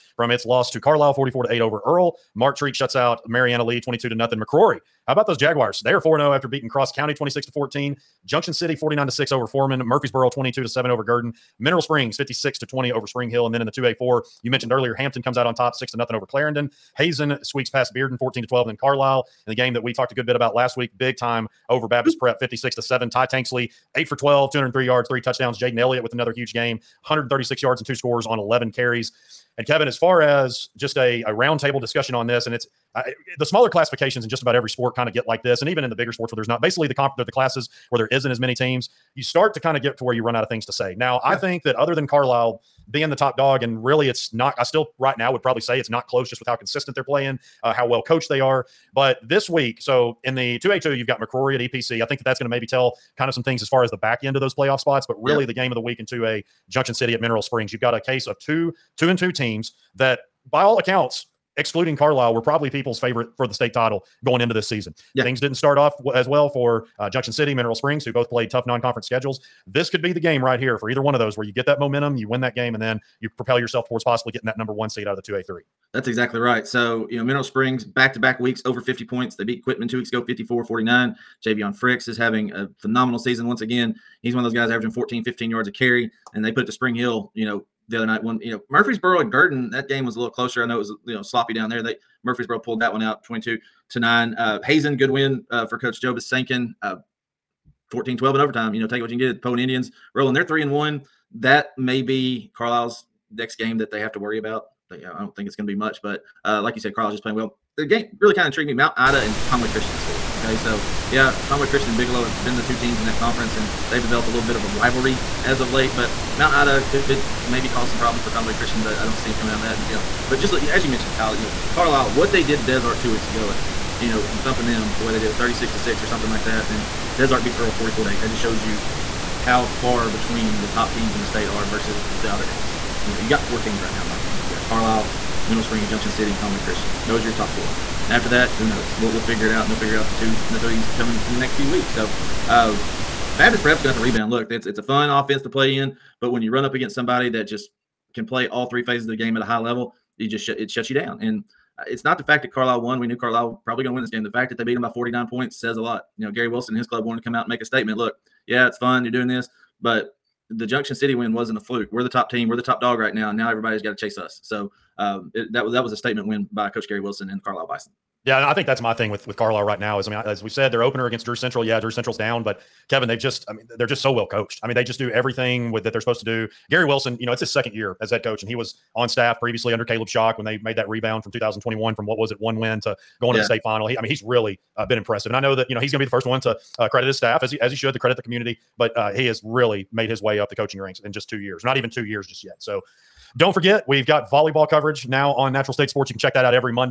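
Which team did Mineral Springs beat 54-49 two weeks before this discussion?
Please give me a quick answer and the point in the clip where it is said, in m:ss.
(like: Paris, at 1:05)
Quitman, at 1:19.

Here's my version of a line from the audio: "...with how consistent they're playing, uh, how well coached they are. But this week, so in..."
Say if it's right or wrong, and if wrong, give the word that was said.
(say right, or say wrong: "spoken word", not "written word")
right.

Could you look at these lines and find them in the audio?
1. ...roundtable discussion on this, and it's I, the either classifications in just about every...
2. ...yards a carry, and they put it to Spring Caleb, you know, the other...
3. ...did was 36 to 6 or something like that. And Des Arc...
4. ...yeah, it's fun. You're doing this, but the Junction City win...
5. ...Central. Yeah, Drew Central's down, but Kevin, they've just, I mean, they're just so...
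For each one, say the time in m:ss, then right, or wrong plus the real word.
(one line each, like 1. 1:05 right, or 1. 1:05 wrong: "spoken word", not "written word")
1. 0:31 wrong: "smaller", not "either"
2. 1:25 wrong: "Hill", not "Caleb"
3. 2:05 right
4. 2:38 right
5. 2:51 right.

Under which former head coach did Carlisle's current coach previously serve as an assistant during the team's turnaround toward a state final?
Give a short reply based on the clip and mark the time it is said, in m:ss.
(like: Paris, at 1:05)
Caleb Shock, at 2:59.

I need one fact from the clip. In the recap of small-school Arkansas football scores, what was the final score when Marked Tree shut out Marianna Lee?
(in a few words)
22-0.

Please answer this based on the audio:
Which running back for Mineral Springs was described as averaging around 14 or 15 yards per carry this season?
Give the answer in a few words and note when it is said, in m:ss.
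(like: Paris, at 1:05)
Javion Fricks, at 1:21.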